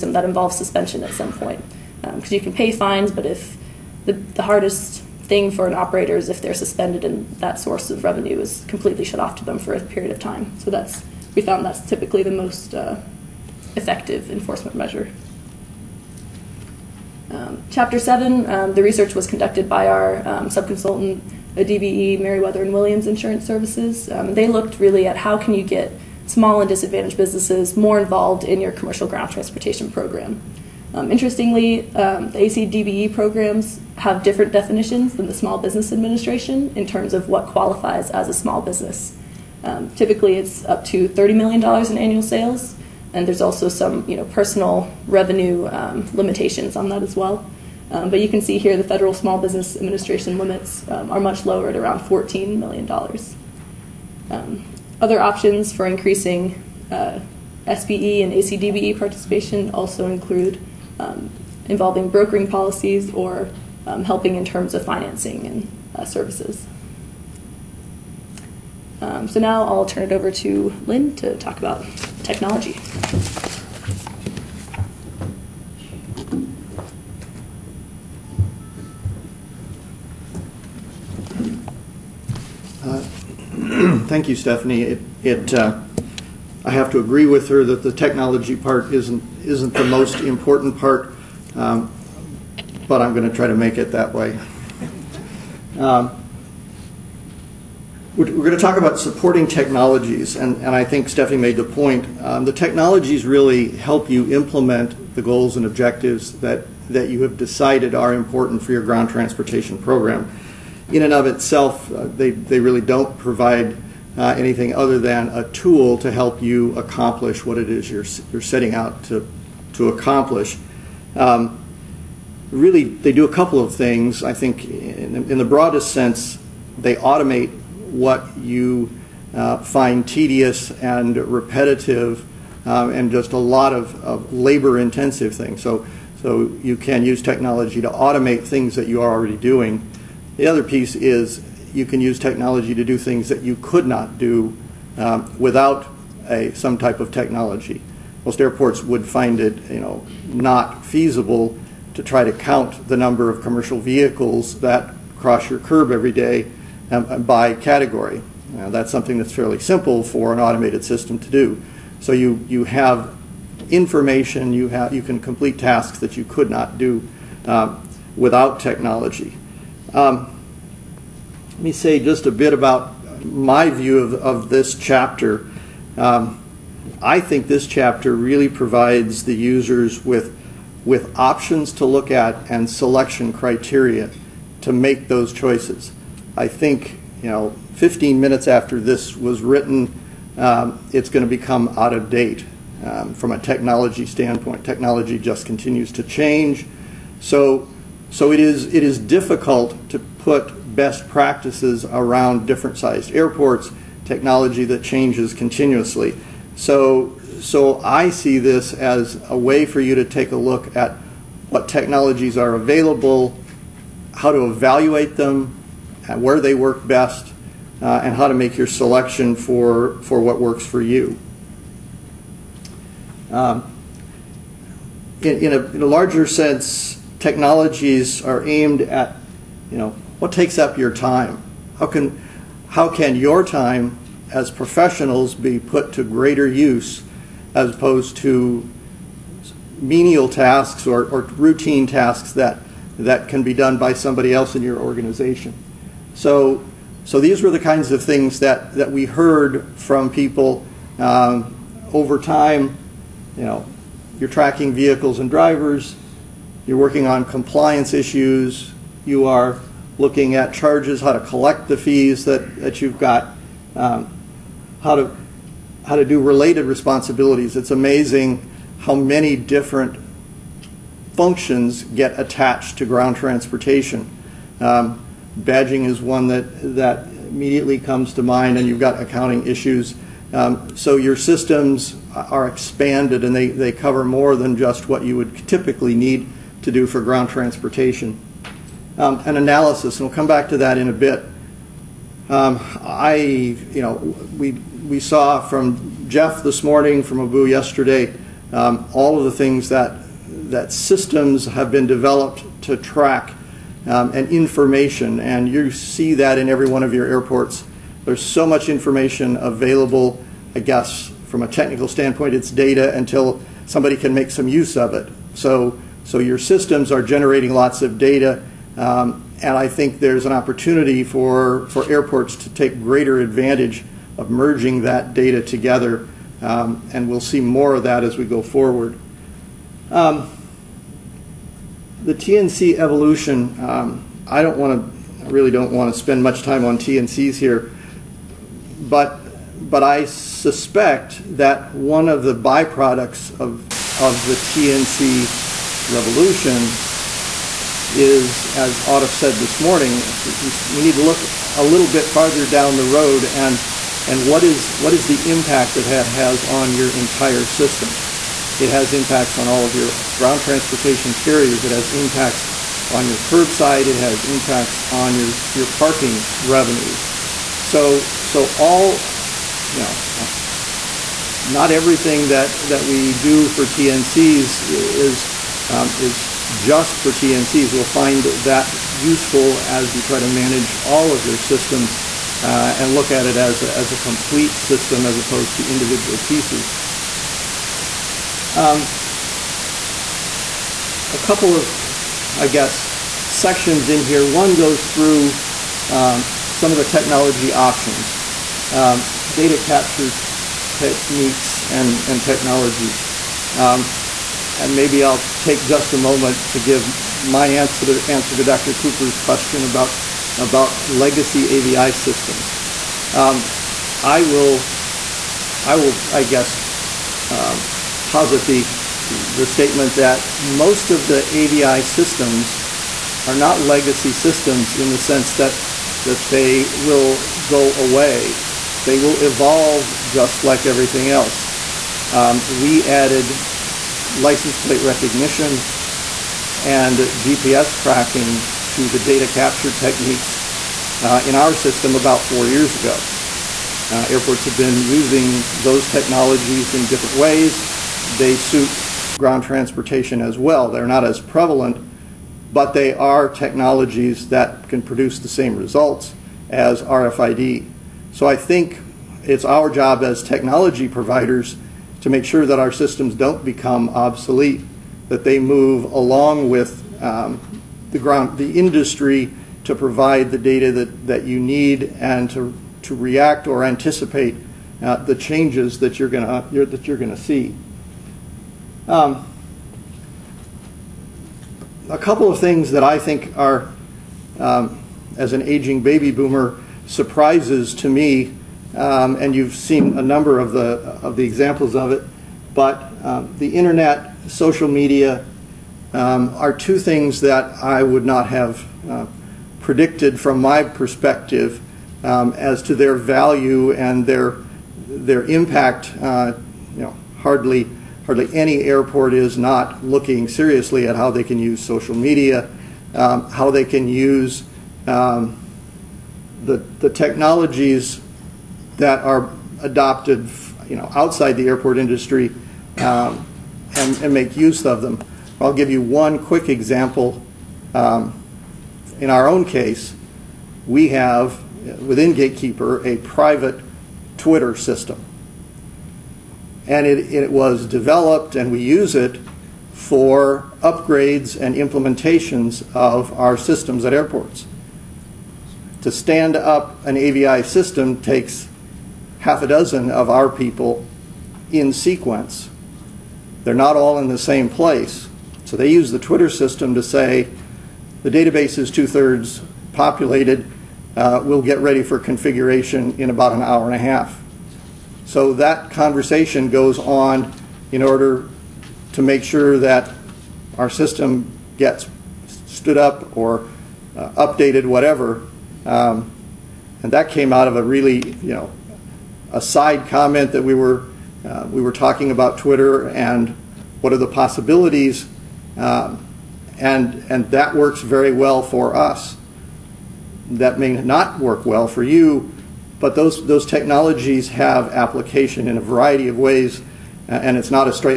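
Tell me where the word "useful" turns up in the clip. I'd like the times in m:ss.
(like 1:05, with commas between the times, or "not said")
6:18.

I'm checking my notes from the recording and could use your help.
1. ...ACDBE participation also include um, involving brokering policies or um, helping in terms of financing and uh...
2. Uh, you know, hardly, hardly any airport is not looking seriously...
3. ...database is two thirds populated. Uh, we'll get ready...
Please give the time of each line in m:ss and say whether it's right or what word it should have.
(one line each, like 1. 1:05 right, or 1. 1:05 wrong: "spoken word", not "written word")
1. 0:58 right
2. 8:25 right
3. 9:18 right.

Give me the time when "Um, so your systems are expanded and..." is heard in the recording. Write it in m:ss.
4:40.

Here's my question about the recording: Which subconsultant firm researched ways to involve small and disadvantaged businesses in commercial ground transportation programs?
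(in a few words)
Meriwether and Williams Insurance Services.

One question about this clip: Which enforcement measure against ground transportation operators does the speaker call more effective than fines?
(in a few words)
Suspension.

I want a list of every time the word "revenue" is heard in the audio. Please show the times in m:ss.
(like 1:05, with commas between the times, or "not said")
0:08, 0:45, 6:06.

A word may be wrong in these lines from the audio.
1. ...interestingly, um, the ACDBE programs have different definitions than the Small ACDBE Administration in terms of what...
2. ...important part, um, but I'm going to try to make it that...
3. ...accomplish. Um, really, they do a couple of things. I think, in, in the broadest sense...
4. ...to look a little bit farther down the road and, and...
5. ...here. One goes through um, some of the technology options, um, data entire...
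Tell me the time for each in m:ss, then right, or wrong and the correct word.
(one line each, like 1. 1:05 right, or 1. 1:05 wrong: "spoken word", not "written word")
1. 0:31 wrong: "Business", not "ACDBE"
2. 1:30 right
3. 1:59 right
4. 5:50 right
5. 6:34 wrong: "capture", not "entire".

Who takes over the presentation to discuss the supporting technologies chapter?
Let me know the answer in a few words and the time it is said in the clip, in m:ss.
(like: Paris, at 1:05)
Lynn, at 1:10.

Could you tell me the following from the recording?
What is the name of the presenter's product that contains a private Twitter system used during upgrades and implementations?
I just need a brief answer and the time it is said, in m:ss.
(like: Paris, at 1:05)
Gatekeeper, at 8:52.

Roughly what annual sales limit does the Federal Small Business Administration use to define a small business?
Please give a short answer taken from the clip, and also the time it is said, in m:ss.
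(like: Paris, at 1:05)
$14 million, at 0:52.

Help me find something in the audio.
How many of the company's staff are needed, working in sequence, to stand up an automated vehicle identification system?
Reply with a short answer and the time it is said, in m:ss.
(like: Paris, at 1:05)
Half a dozen, at 9:09.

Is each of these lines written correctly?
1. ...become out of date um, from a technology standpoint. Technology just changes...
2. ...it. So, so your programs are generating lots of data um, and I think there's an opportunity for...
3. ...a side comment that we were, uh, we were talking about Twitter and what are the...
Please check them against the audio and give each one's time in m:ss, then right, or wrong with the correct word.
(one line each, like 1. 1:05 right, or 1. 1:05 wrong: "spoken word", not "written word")
1. 3:11 wrong: "continues", not "changes"
2. 5:14 wrong: "systems", not "programs"
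3. 9:39 right.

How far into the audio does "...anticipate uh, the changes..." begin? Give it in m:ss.
7:53.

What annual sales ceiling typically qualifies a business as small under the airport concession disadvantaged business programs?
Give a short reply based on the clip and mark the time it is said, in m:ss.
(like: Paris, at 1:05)
$30 million, at 0:41.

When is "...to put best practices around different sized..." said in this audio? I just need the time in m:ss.
3:19.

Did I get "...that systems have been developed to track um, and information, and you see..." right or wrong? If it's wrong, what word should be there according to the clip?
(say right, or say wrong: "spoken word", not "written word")
right.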